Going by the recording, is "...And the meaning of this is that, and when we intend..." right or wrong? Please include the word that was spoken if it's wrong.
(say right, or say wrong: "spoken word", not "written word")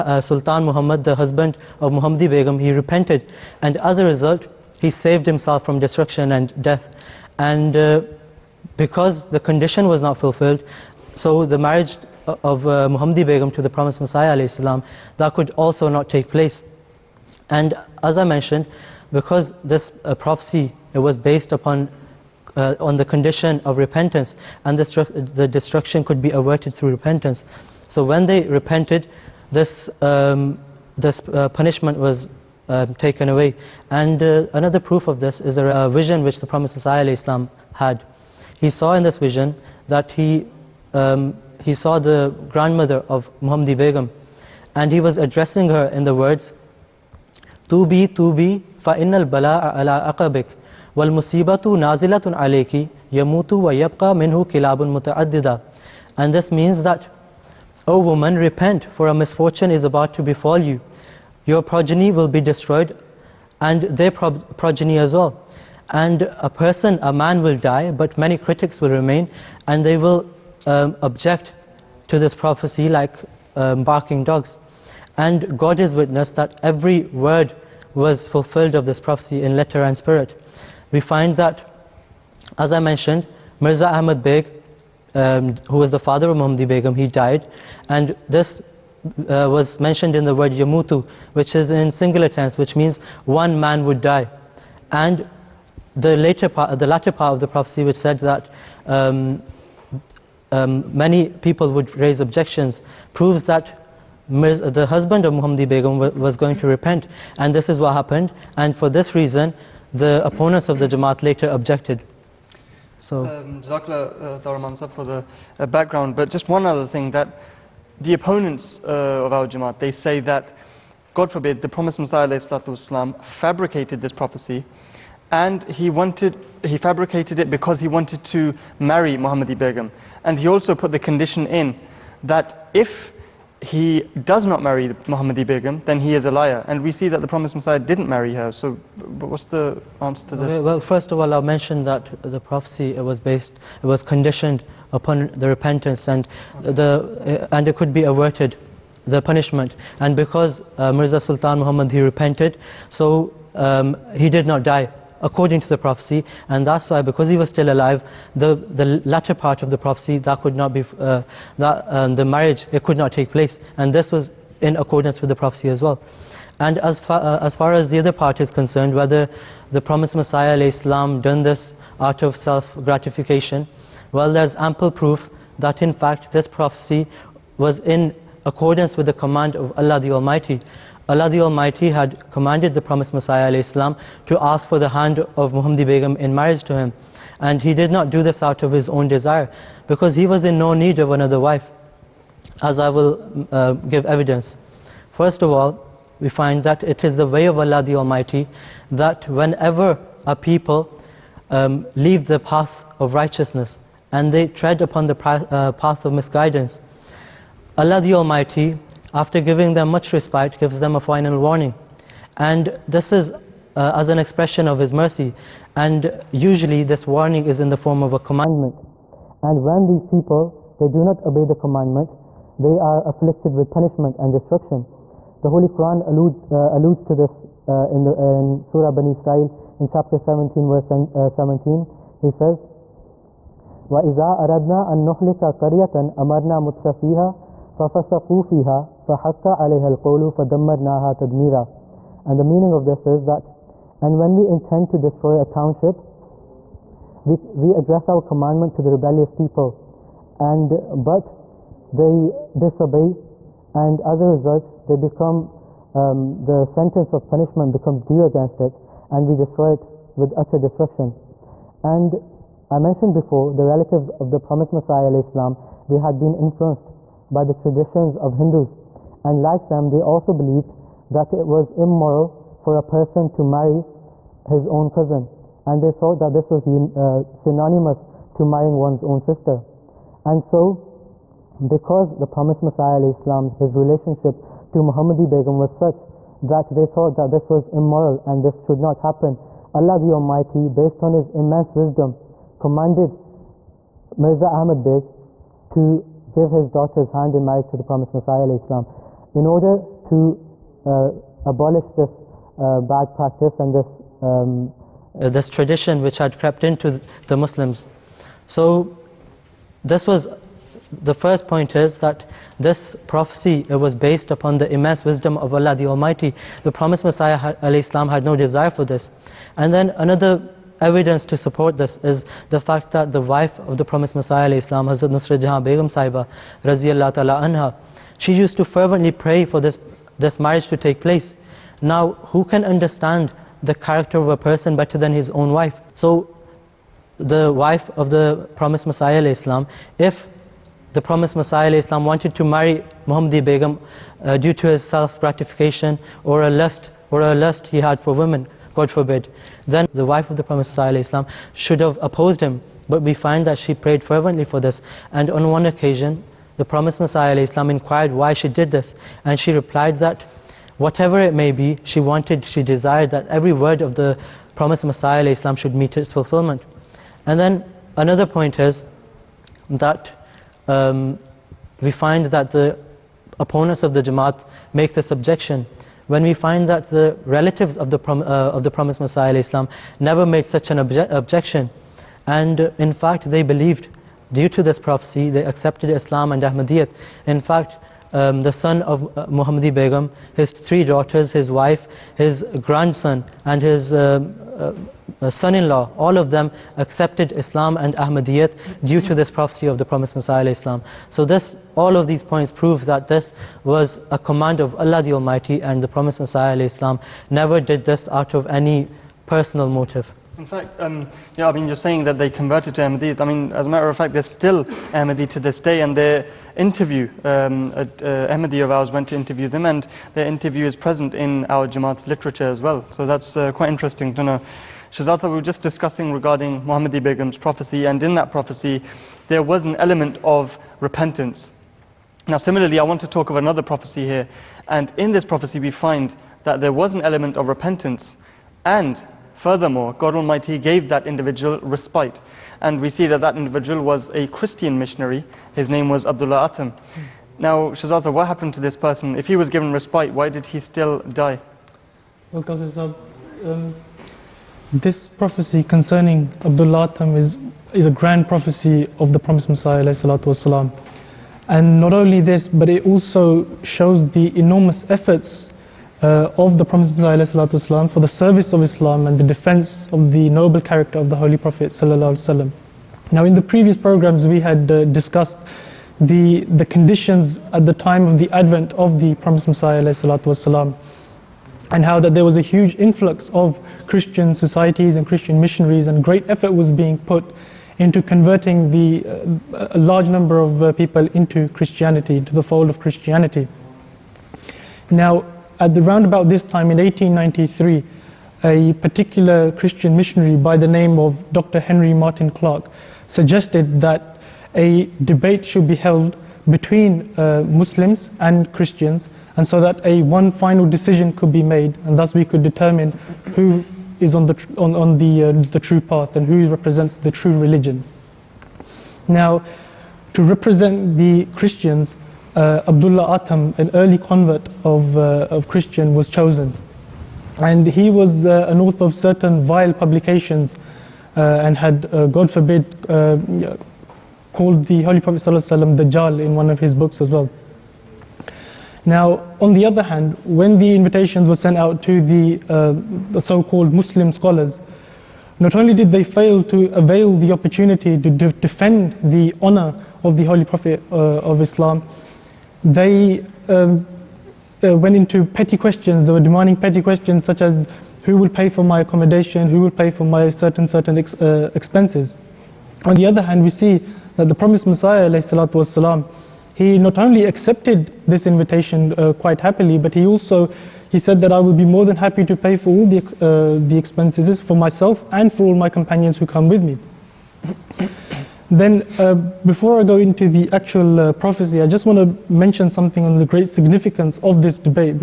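right.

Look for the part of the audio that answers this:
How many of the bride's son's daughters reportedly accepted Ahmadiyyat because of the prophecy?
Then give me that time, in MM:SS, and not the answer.
06:30.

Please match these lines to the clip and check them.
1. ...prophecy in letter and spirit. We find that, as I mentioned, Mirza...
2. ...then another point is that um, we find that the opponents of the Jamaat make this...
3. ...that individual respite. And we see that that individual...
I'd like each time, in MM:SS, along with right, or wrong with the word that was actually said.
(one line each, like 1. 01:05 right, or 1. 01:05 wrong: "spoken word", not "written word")
1. 01:18 right
2. 06:07 right
3. 07:20 right.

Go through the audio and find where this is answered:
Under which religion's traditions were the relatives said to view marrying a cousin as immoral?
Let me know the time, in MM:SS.
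04:28.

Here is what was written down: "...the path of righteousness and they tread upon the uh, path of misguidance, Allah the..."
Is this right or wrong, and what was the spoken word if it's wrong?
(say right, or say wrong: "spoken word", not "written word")
right.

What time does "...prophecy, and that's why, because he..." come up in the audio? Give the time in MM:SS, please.
02:35.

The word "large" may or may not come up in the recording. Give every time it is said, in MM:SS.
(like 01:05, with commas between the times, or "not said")
08:09.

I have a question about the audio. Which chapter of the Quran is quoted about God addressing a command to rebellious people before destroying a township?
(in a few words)
Surah Bani Israel.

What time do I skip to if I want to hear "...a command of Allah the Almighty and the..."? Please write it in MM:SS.
06:44.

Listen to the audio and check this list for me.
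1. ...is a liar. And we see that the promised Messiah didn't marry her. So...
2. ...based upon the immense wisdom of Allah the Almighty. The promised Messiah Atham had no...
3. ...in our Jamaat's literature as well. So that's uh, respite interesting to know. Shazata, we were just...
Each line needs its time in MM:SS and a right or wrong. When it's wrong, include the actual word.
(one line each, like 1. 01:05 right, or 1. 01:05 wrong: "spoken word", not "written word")
1. 02:16 right
2. 05:13 wrong: "Islam", not "Atham"
3. 07:01 wrong: "quite", not "respite".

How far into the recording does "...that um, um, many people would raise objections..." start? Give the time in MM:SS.
01:38.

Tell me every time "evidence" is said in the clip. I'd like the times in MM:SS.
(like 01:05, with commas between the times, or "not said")
03:14, 05:20.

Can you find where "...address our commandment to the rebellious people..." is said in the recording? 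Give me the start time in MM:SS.
04:07.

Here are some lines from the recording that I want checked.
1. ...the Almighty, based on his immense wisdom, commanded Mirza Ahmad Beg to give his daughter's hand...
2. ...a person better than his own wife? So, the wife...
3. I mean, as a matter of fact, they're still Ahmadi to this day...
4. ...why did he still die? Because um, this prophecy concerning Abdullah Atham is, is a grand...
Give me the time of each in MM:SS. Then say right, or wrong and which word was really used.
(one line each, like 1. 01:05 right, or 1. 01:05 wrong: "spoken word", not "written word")
1. 04:49 right
2. 05:34 right
3. 06:53 right
4. 07:30 right.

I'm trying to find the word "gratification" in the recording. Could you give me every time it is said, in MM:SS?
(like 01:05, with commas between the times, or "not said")
02:52, 05:44.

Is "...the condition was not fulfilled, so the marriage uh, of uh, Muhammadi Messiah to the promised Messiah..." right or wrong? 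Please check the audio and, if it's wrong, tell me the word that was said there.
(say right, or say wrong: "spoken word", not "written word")
wrong: "Begum", not "Messiah".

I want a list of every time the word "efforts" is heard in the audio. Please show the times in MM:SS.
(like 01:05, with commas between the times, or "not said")
07:44, 08:06.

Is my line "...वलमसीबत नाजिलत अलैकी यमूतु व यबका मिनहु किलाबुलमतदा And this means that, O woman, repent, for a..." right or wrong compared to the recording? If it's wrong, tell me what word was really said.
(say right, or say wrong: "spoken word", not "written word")
right.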